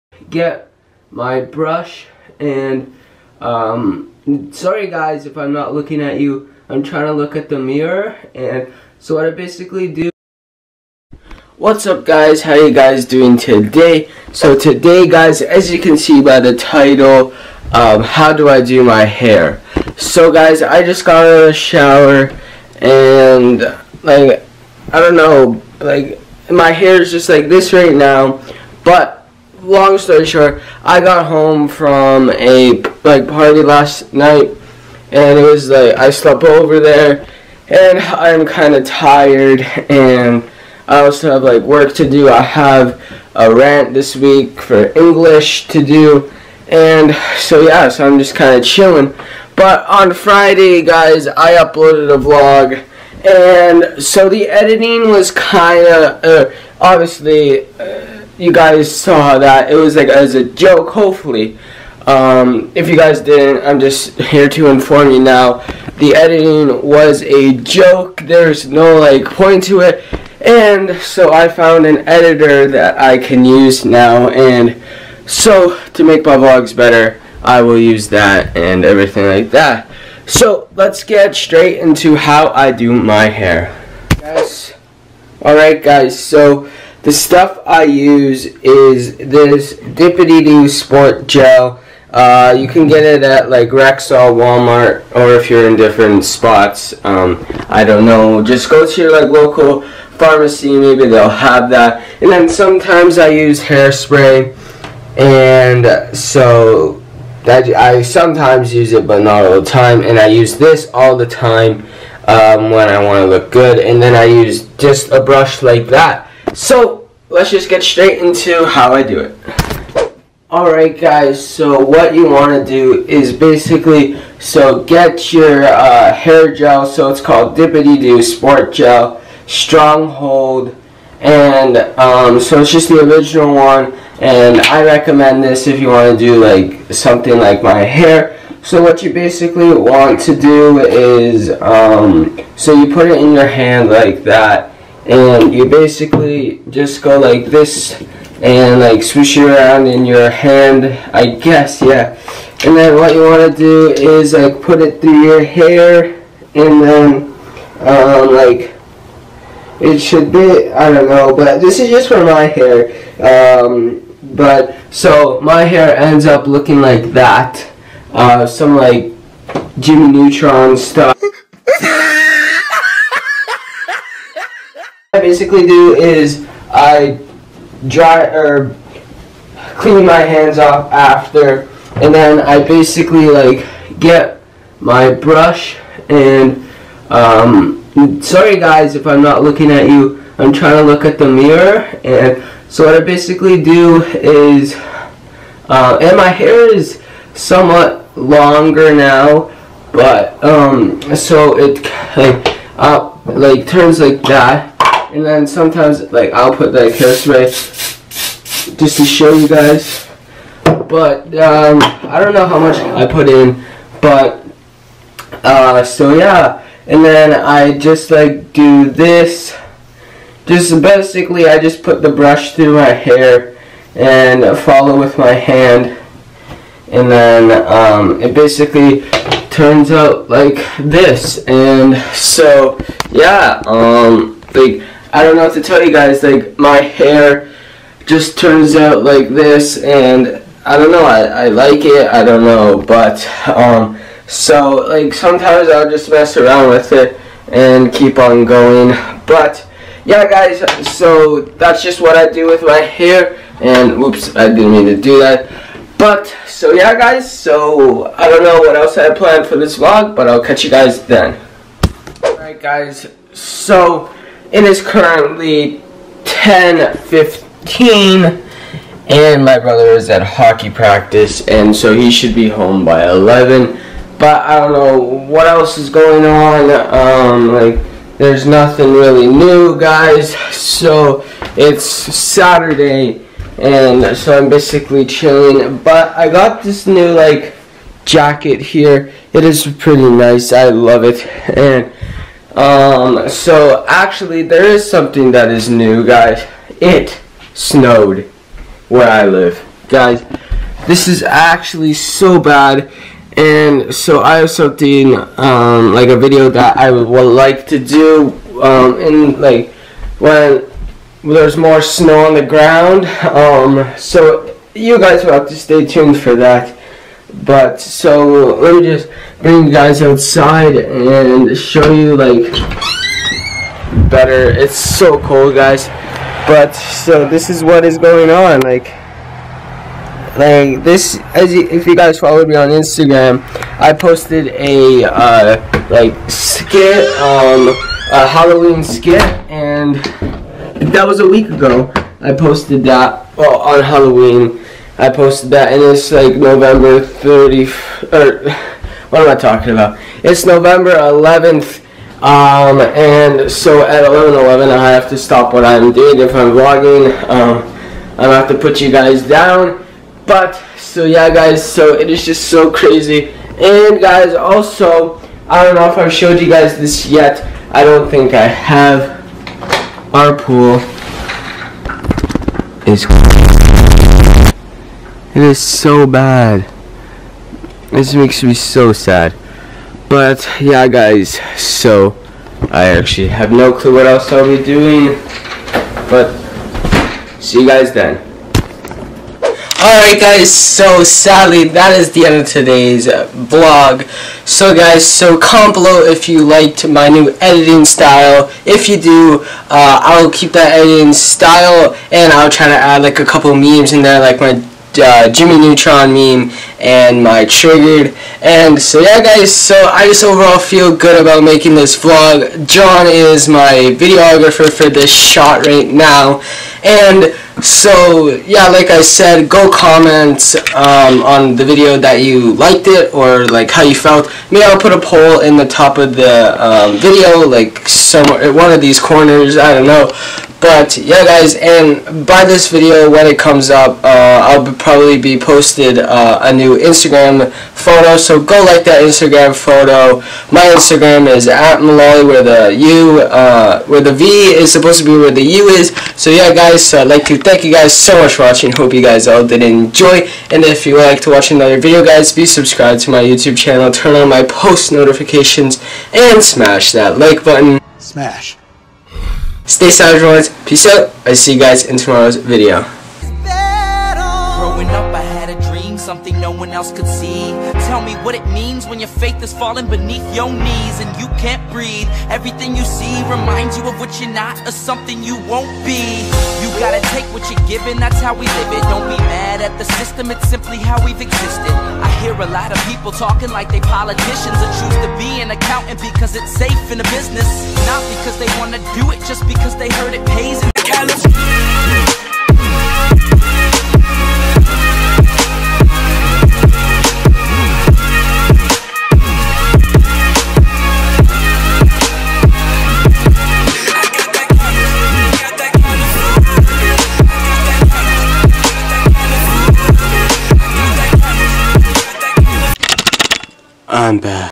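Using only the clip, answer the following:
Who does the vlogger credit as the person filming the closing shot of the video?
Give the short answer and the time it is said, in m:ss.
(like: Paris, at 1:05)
John, at 6:52.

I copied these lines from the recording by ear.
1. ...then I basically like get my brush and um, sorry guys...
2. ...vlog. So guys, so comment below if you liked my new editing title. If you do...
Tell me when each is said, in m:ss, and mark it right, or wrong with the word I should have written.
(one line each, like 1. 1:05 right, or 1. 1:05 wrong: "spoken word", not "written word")
1. 3:02 right
2. 6:33 wrong: "style", not "title".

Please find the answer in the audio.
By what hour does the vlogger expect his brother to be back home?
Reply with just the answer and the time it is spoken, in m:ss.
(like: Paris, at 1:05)
11, at 4:33.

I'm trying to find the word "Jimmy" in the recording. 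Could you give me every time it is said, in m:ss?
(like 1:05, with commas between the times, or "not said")
2:49, 6:45.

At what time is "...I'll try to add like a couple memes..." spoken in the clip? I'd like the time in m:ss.
6:42.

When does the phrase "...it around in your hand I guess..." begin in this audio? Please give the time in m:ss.
2:29.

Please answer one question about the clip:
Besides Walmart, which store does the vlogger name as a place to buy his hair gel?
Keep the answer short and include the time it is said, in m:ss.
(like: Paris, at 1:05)
Rexall, at 1:33.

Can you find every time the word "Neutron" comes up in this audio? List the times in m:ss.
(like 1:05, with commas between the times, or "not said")
2:50, 6:45.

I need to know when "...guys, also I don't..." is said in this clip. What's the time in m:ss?
6:03.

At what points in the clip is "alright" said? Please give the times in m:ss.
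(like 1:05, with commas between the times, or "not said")
1:25, 2:00, 4:22, 6:29.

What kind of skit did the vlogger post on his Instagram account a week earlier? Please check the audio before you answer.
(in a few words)
Halloween skit.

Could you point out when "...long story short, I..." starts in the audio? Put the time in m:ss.
0:29.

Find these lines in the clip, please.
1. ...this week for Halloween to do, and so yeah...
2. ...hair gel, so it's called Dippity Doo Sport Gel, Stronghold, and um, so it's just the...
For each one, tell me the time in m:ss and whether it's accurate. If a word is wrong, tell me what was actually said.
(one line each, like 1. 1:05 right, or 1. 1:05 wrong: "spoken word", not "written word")
1. 0:43 wrong: "English", not "Halloween"
2. 2:06 right.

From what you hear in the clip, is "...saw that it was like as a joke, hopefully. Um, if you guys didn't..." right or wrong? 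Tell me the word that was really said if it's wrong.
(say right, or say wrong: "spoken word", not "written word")
right.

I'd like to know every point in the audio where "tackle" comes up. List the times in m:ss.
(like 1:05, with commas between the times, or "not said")
not said.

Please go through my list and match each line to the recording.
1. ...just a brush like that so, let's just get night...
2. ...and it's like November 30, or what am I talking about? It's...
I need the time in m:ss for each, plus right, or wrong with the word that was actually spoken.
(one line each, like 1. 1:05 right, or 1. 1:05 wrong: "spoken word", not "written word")
1. 1:54 wrong: "straight", not "night"
2. 5:45 right.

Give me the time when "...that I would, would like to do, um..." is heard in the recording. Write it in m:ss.
5:06.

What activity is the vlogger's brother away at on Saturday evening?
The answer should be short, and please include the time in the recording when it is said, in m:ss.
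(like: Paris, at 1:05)
hockey practice, at 4:30.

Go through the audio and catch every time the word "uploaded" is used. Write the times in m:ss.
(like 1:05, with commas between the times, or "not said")
0:51.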